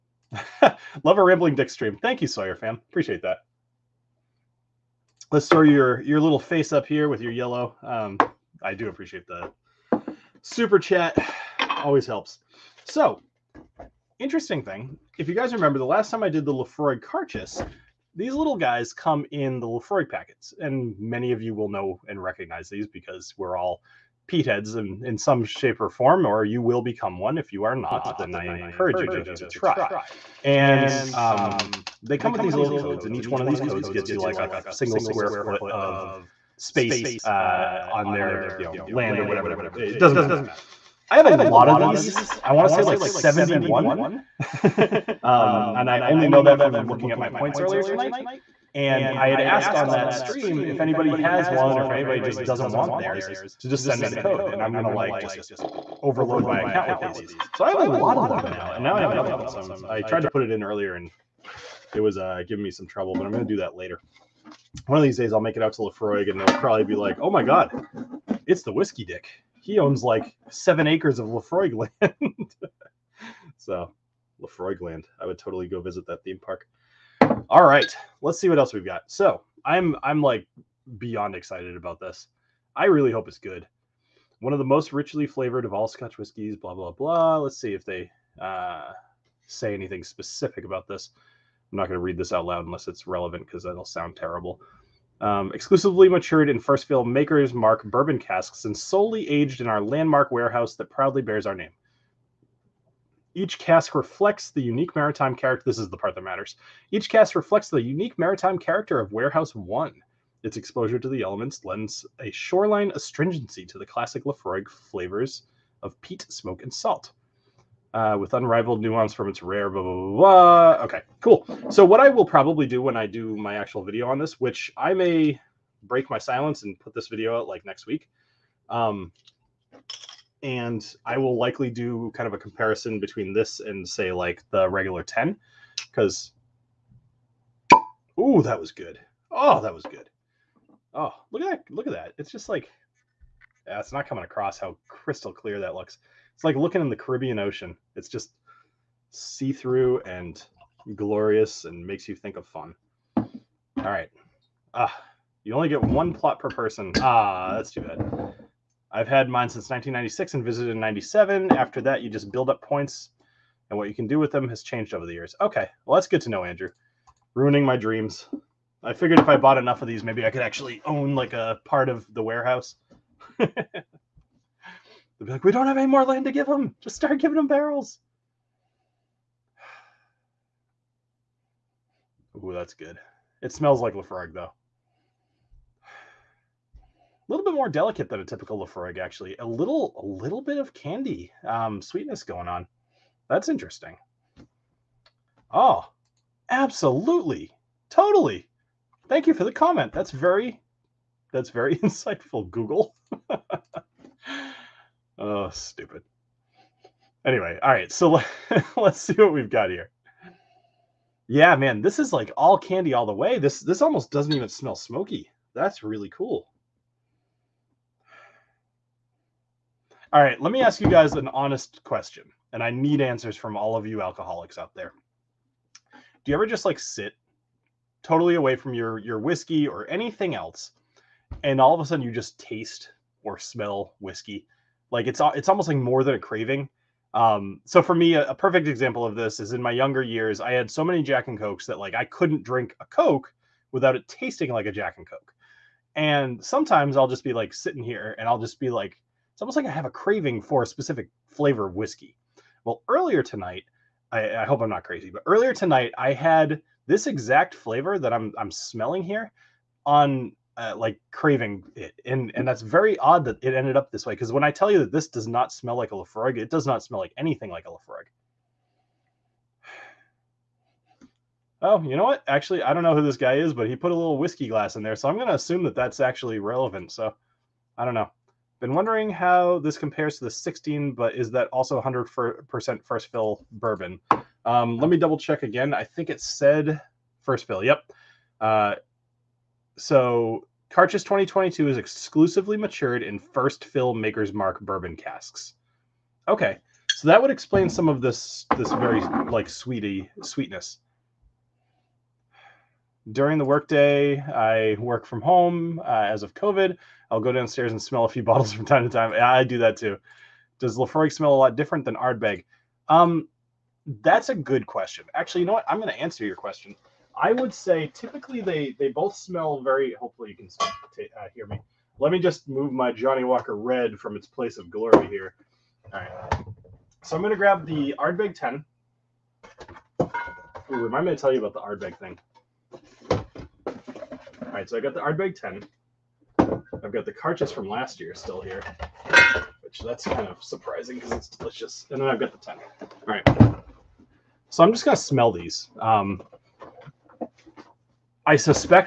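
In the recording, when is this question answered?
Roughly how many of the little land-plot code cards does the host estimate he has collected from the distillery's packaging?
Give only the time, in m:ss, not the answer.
0:43.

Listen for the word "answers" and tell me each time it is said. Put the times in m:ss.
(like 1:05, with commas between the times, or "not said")
3:43, 5:16.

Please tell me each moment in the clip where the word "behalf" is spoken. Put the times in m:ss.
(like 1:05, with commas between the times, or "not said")
not said.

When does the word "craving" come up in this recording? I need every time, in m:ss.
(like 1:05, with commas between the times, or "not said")
3:56, 4:09, 4:21.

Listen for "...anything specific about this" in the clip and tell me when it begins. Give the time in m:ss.
1:29.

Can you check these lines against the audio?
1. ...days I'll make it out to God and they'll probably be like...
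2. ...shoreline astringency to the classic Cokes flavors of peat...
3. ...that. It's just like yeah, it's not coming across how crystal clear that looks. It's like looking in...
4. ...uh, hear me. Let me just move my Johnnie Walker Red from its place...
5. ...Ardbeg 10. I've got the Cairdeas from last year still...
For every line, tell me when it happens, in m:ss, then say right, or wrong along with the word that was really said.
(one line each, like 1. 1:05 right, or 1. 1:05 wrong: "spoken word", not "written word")
1. 1:05 wrong: "Laphroaig", not "God"
2. 1:52 wrong: "Laphroaig", not "Cokes"
3. 2:21 right
4. 5:21 right
5. 5:35 right.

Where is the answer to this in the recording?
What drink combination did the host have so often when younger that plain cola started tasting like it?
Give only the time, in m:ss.
4:01.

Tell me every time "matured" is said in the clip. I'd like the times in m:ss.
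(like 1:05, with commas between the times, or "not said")
1:36, 4:52.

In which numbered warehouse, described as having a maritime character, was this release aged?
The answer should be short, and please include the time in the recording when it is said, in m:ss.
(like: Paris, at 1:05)
Warehouse 1, at 1:49.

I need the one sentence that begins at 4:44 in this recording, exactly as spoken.
Um, let me double check again.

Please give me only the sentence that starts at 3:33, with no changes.
This this almost doesn't even smell smoky.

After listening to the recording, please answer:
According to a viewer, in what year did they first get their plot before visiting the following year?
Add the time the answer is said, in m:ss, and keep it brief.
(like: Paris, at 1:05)
1996, at 2:39.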